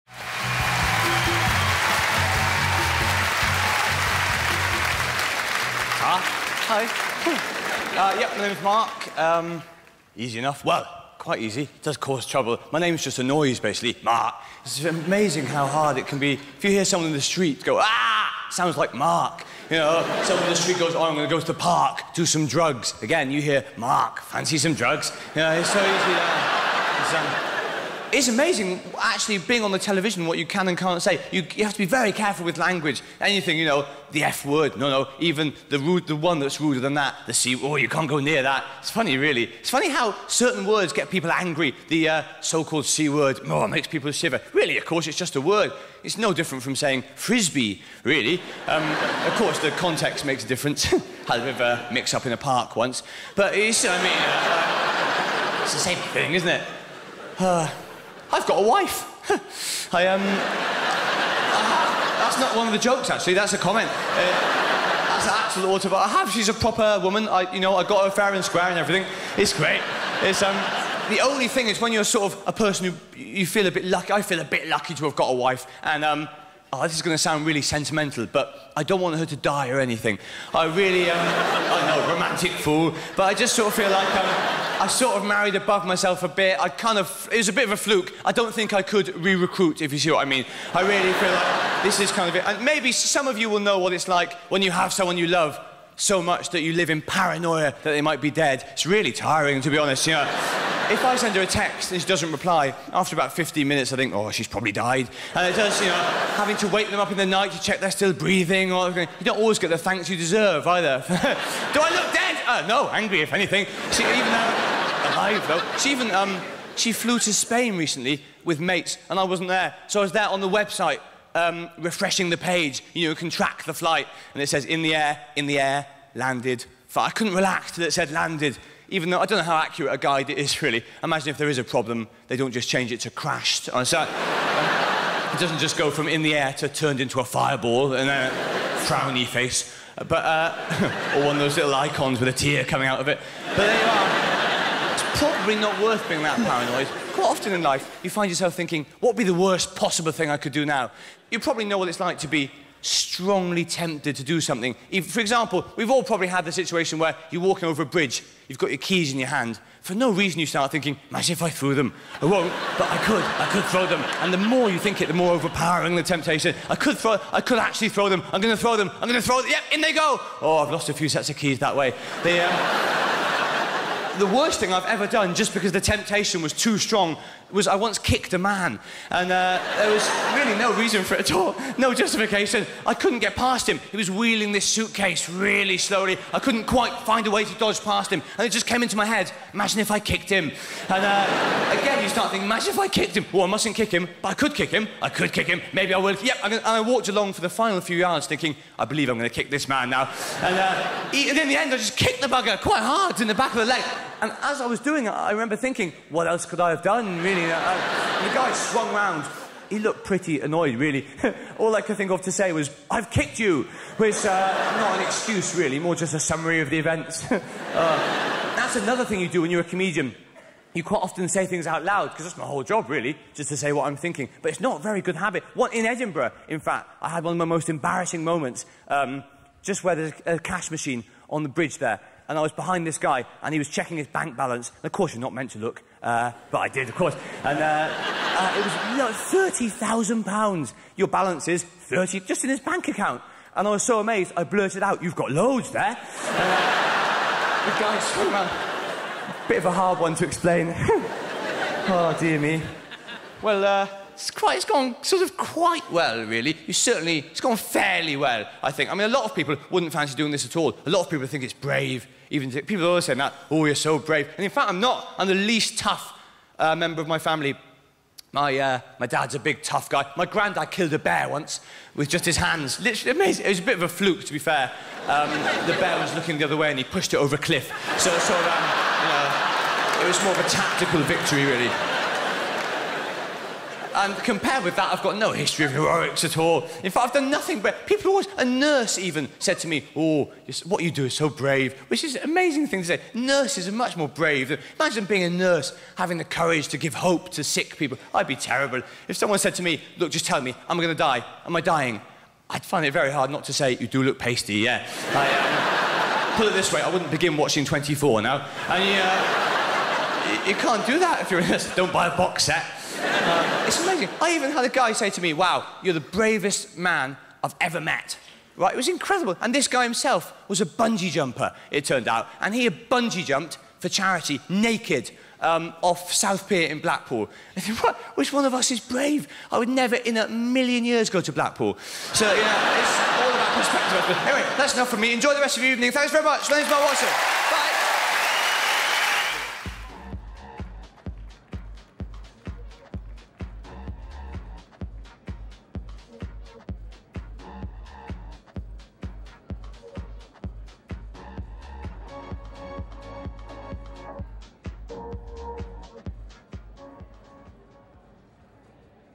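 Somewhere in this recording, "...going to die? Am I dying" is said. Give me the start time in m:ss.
5:00.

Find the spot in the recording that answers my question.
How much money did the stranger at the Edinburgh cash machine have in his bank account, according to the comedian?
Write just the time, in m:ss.
3:59.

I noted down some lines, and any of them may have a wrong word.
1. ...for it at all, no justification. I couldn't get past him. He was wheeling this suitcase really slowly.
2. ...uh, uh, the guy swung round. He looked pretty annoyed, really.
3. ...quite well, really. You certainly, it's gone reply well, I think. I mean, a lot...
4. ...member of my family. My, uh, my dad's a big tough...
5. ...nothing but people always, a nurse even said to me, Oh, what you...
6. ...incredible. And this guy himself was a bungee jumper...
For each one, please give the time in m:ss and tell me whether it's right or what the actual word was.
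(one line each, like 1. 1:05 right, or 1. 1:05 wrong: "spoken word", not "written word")
1. 3:01 right
2. 3:27 right
3. 4:15 wrong: "fairly", not "reply"
4. 4:26 right
5. 4:47 right
6. 5:18 right.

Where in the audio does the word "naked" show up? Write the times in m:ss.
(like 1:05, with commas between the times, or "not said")
5:24.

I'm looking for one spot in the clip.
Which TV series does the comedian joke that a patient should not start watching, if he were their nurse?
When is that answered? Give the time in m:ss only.
5:07.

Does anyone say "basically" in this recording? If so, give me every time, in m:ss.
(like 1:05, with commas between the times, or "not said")
0:13.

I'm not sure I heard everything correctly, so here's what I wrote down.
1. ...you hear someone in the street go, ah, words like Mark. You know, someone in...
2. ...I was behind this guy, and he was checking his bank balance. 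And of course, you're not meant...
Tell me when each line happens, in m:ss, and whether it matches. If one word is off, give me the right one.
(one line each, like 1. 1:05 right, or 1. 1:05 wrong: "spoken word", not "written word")
1. 0:16 wrong: "sounds", not "words"
2. 3:52 right.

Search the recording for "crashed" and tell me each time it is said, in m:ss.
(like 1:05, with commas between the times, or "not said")
2:13.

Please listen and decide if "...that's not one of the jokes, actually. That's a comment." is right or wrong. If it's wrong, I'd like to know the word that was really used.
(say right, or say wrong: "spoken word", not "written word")
right.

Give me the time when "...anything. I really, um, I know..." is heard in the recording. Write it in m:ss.
1:19.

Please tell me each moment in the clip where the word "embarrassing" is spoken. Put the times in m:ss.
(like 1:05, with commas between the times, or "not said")
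3:47.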